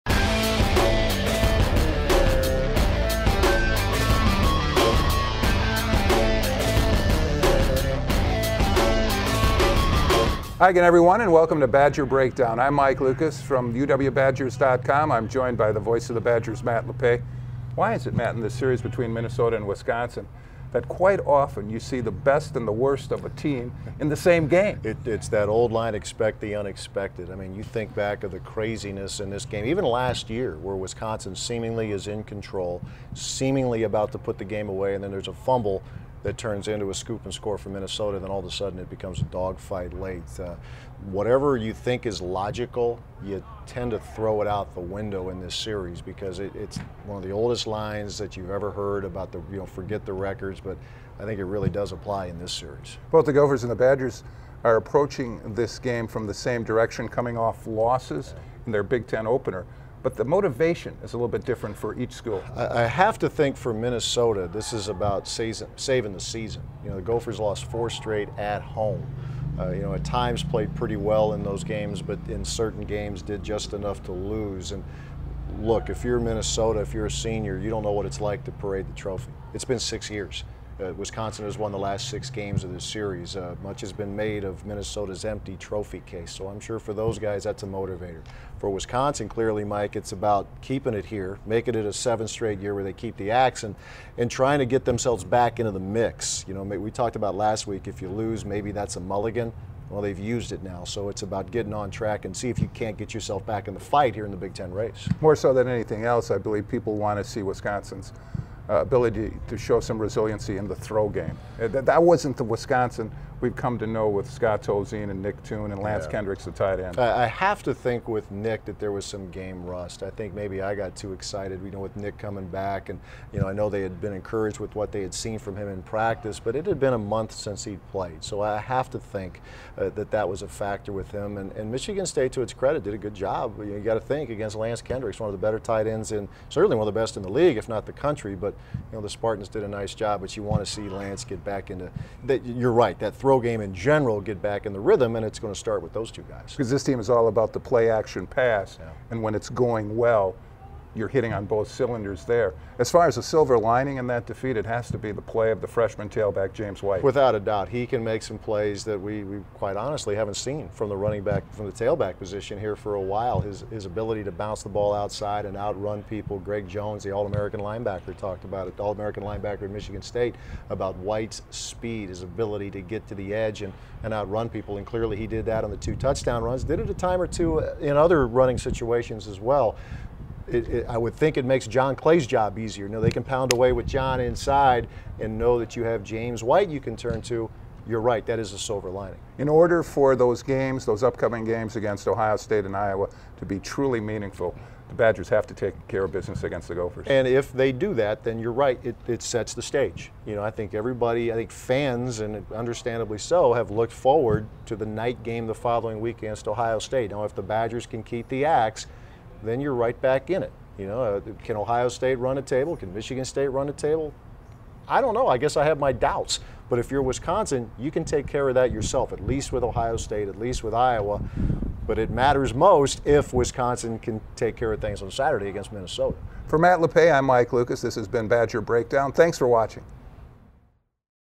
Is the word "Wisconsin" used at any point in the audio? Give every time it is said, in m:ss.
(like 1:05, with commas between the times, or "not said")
0:19, 0:30, 1:20, 1:28, 1:47, 1:52, 3:37, 3:43.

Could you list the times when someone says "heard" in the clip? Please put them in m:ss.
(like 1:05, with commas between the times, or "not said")
0:48.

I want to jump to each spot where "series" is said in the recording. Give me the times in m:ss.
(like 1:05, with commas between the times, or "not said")
0:18, 0:45, 0:52, 1:22.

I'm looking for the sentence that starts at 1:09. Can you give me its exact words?
Uh, you know, at times played pretty well in those games, but in certain games did just enough to lose.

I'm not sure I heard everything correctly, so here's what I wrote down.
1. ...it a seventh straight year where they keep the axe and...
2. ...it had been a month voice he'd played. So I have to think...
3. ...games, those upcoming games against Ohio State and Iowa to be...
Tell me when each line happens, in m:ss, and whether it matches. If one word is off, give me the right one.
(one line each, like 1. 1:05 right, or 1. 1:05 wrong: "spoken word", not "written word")
1. 1:31 right
2. 2:06 wrong: "since", not "voice"
3. 3:10 right.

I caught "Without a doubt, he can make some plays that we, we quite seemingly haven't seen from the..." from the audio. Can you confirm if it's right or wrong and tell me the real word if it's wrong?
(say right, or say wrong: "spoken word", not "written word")
wrong: "honestly", not "seemingly".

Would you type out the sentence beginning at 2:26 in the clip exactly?
Because this team is all about the play action pass, yeah.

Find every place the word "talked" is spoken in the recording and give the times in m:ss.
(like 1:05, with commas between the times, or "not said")
1:36, 2:48.